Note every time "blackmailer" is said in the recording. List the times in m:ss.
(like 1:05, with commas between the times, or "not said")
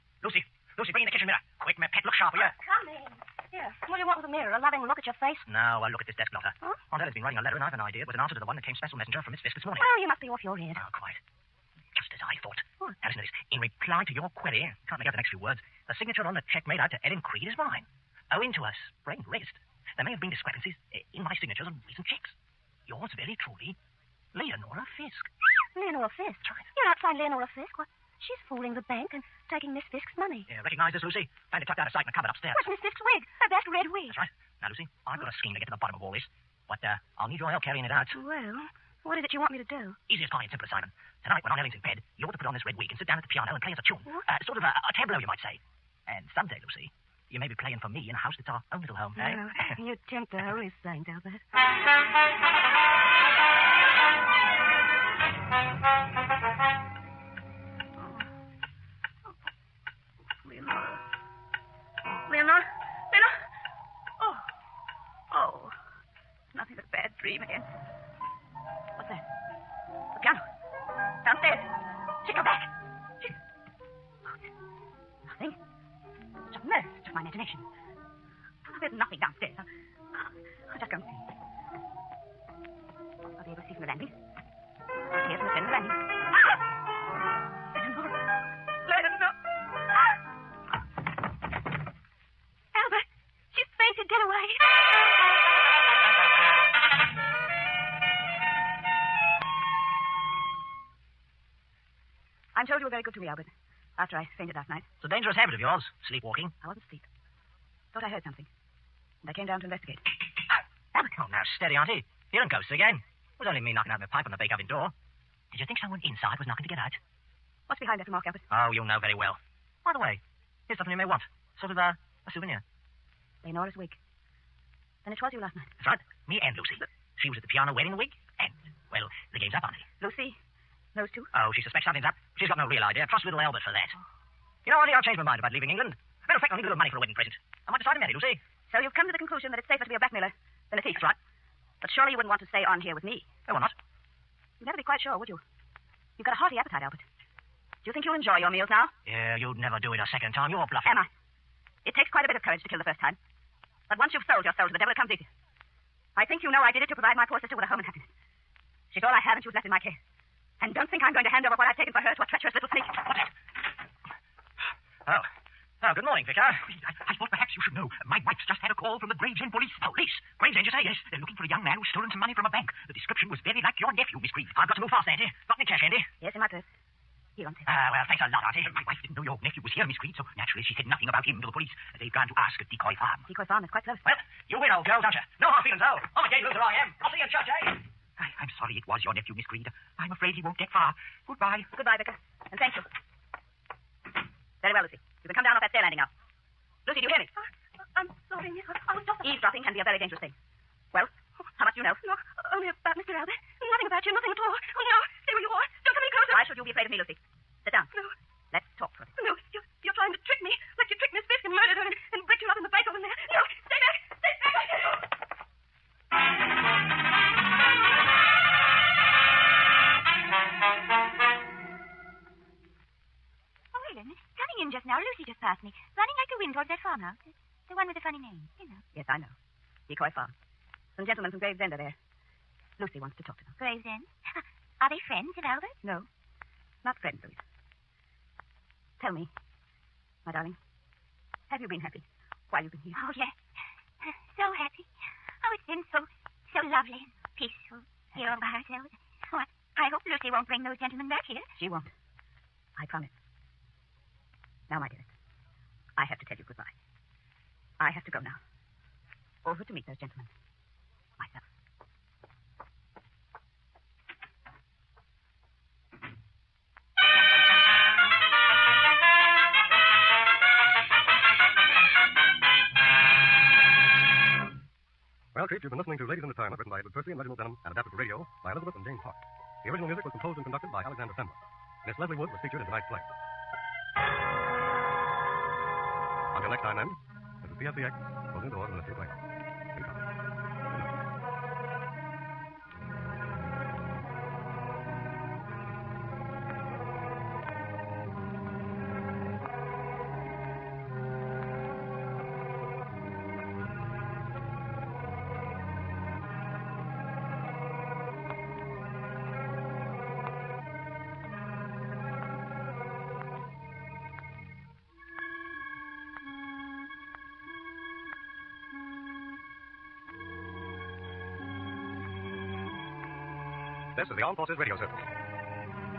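2:19.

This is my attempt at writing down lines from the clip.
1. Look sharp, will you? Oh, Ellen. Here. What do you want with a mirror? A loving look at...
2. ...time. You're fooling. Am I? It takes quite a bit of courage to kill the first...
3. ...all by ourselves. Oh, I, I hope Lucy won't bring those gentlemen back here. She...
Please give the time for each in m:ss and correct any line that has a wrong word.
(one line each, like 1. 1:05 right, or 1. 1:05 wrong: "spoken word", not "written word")
1. 0:02 wrong: "Coming", not "Ellen"
2. 2:30 wrong: "bluffing", not "fooling"
3. 4:08 right.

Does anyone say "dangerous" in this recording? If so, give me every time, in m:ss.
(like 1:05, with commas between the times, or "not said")
1:45, 3:19.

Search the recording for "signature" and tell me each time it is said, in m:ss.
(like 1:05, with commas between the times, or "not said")
0:16, 0:21.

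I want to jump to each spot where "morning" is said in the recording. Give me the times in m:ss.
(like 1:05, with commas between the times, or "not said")
0:09, 2:46.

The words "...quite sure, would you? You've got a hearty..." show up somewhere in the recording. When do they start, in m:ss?
2:24.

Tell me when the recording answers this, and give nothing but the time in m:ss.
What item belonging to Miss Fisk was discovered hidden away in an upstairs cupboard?
0:33.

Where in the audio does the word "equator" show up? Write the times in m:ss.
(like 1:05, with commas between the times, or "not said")
not said.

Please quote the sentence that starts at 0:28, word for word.
She's fooling the bank and taking Miss Fisk's money.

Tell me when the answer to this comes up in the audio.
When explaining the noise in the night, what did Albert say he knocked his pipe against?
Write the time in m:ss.
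1:54.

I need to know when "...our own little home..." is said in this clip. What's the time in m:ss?
0:48.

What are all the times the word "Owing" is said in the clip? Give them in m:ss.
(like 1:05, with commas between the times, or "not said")
0:18.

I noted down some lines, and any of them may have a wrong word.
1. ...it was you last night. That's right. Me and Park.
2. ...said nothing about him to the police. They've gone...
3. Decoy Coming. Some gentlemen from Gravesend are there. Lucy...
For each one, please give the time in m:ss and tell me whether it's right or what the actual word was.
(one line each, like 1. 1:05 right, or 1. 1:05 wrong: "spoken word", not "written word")
1. 2:05 wrong: "Lucy", not "Park"
2. 3:00 right
3. 3:49 wrong: "Farm", not "Coming".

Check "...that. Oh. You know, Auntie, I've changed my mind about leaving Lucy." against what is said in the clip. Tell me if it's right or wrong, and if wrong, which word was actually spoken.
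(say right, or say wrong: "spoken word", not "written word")
wrong: "England", not "Lucy".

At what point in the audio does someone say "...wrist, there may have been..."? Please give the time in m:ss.
0:19.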